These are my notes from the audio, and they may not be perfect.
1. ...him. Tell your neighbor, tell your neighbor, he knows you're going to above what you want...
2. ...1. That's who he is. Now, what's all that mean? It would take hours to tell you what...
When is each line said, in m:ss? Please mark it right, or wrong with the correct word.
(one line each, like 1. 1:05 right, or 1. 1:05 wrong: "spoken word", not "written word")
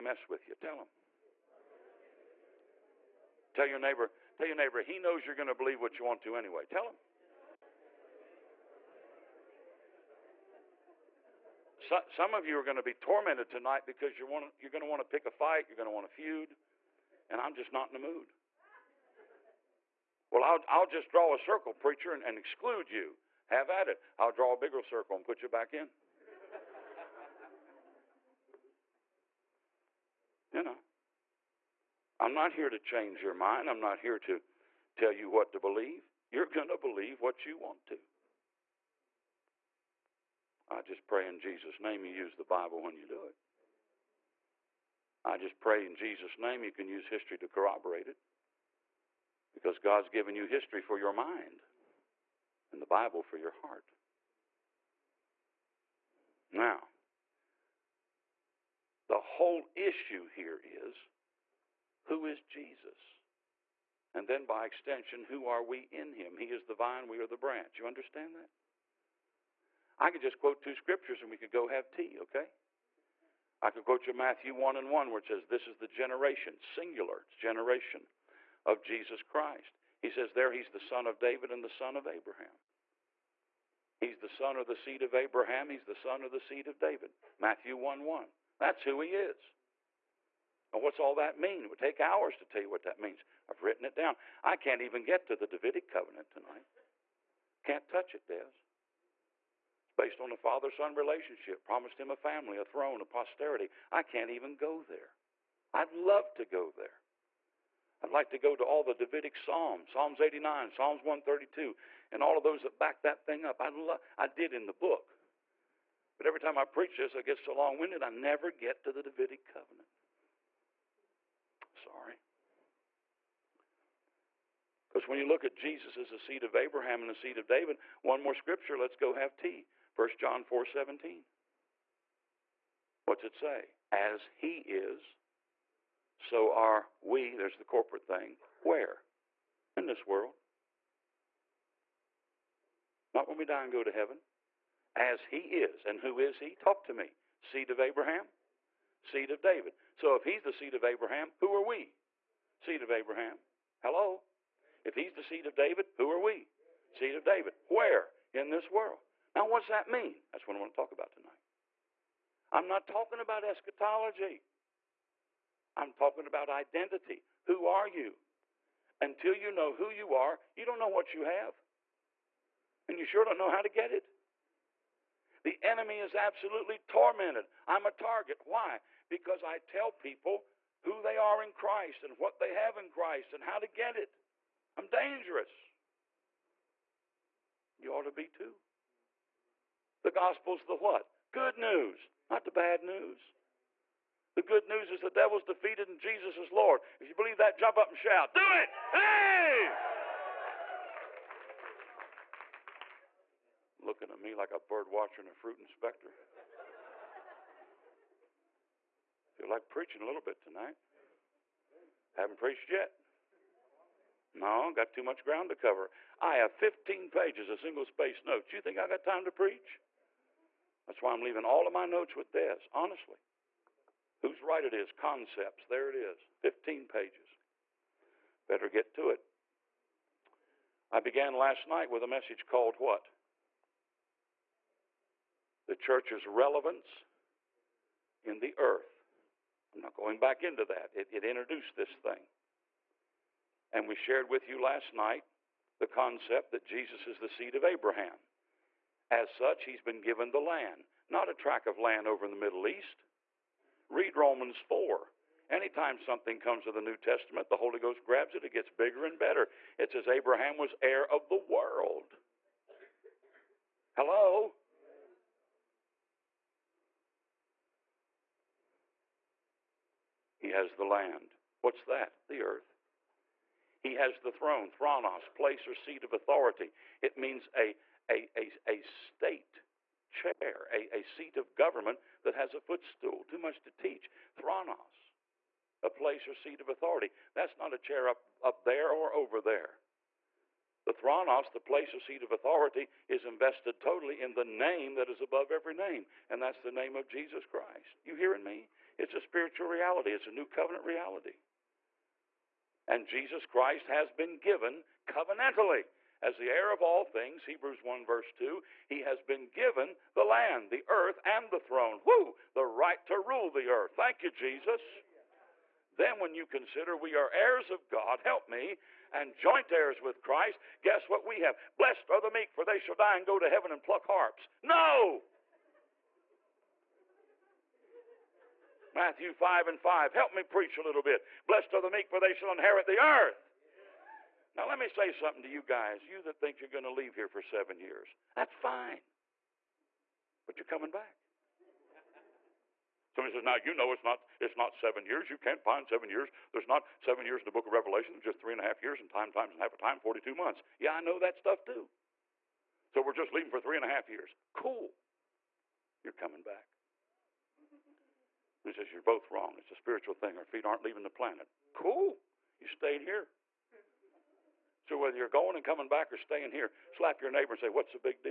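1. 0:00 wrong: "believe", not "above"
2. 1:28 right.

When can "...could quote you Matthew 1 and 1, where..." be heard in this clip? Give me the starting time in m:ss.
1:13.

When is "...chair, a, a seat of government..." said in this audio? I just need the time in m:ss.
4:40.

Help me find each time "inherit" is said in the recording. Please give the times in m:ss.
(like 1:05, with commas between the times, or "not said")
5:32.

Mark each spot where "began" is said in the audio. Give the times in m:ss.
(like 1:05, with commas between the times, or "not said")
3:50.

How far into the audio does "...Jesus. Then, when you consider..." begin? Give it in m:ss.
5:14.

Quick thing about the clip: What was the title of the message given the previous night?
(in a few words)
The church's relevance in the earth.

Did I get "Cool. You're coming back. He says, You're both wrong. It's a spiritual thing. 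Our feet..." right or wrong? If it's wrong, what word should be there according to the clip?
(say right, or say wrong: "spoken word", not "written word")
right.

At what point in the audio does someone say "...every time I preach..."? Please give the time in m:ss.
1:56.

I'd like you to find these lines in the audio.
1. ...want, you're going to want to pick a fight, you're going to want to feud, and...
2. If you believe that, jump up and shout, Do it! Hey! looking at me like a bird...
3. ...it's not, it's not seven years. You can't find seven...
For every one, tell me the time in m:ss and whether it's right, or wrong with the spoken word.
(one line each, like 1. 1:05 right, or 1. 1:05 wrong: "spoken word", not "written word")
1. 0:14 right
2. 3:16 right
3. 5:43 right.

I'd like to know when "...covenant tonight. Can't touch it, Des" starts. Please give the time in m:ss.
1:35.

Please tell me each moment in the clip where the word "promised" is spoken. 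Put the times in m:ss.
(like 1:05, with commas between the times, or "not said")
1:41.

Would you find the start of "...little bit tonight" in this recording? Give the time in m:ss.
3:30.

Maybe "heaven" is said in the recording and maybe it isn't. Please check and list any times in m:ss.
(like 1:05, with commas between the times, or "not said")
2:23, 5:23.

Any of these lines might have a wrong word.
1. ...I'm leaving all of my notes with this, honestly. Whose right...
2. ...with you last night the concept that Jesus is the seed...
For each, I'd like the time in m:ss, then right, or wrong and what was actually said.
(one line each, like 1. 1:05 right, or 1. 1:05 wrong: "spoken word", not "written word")
1. 3:41 right
2. 4:04 right.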